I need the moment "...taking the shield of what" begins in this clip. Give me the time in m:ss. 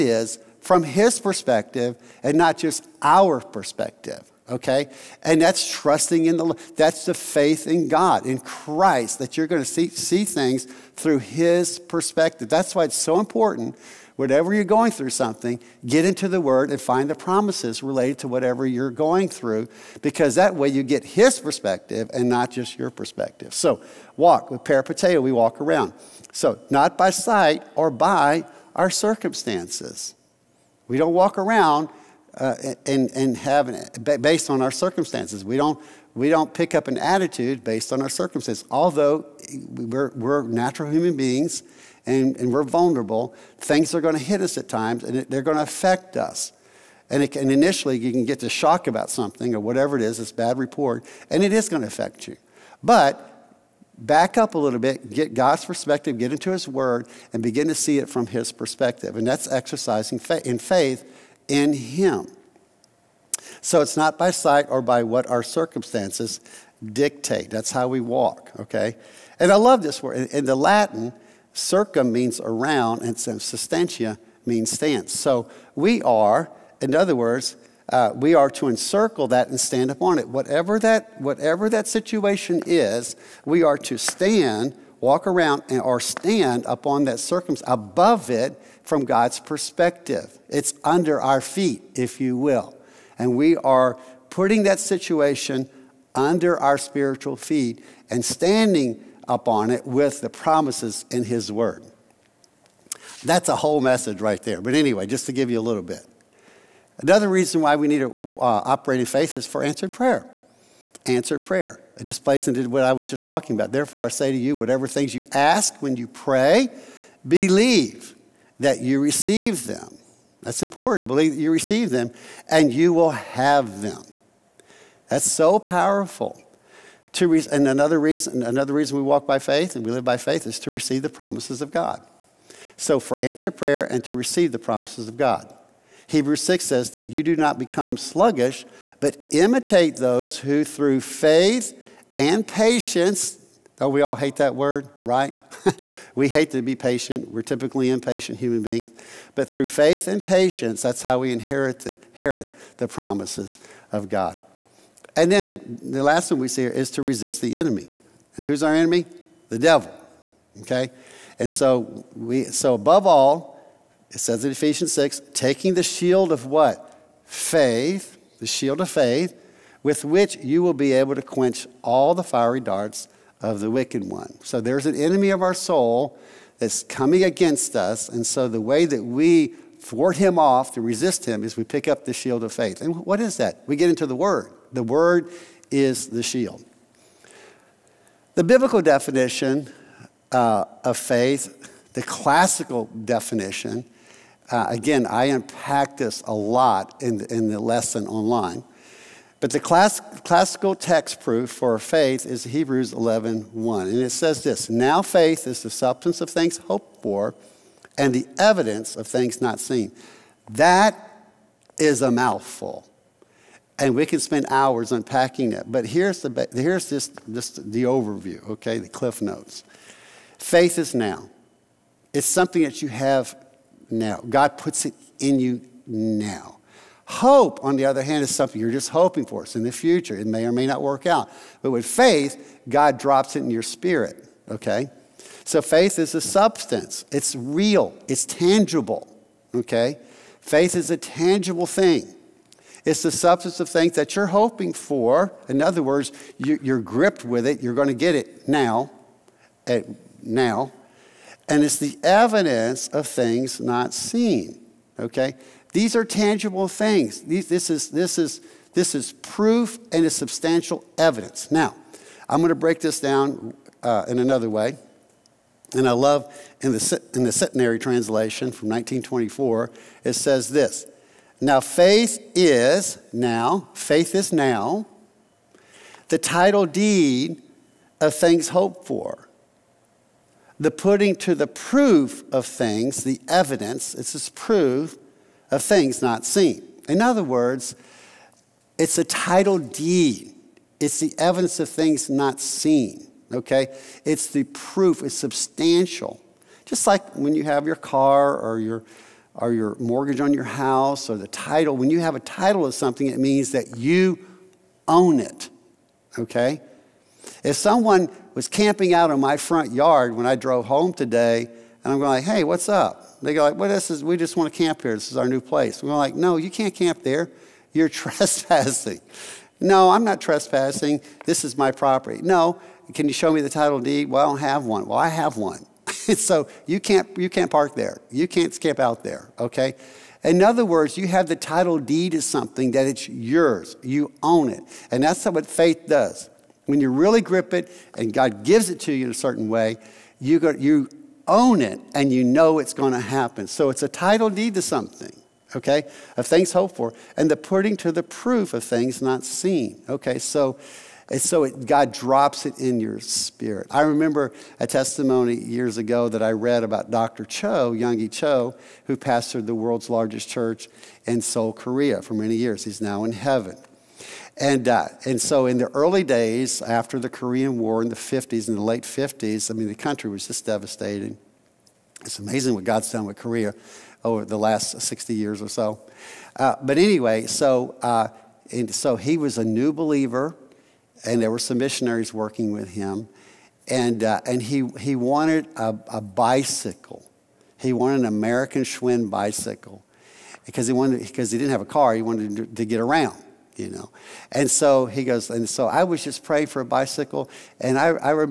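2:45.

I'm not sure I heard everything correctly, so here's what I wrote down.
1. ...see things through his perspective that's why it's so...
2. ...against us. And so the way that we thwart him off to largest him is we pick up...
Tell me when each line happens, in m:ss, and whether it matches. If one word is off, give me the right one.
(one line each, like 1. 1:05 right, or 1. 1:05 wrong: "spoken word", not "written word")
1. 0:09 right
2. 2:57 wrong: "resist", not "largest".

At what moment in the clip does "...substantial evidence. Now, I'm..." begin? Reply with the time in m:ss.
4:20.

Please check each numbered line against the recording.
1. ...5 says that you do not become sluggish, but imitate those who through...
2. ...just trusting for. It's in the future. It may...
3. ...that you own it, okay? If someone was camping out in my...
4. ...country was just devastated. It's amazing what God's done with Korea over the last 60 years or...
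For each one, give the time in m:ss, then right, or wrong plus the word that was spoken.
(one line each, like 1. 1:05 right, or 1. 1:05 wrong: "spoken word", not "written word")
1. 2:16 wrong: "6", not "5"
2. 3:48 wrong: "hoping", not "trusting"
3. 5:03 right
4. 6:09 right.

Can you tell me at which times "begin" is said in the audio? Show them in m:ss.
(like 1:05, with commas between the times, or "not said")
0:57.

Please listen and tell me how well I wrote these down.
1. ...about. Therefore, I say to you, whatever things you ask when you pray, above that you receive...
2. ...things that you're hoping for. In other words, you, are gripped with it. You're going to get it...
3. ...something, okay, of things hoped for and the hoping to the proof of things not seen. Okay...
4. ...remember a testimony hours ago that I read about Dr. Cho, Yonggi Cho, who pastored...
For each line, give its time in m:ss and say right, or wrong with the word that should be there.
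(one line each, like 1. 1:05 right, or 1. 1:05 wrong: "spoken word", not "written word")
1. 1:53 wrong: "believe", not "above"
2. 4:03 right
3. 5:44 wrong: "putting", not "hoping"
4. 5:53 wrong: "years", not "hours".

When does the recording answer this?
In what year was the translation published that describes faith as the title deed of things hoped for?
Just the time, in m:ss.
4:28.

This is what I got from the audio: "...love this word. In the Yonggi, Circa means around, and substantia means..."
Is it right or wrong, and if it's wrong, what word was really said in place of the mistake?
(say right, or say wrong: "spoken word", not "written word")
wrong: "Latin", not "Yonggi".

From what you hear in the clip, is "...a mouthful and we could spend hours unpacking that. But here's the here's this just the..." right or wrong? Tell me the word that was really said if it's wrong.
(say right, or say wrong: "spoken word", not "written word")
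right.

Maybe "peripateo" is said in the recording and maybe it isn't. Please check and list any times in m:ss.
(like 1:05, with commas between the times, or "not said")
0:24.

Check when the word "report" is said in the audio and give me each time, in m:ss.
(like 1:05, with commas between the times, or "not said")
0:50.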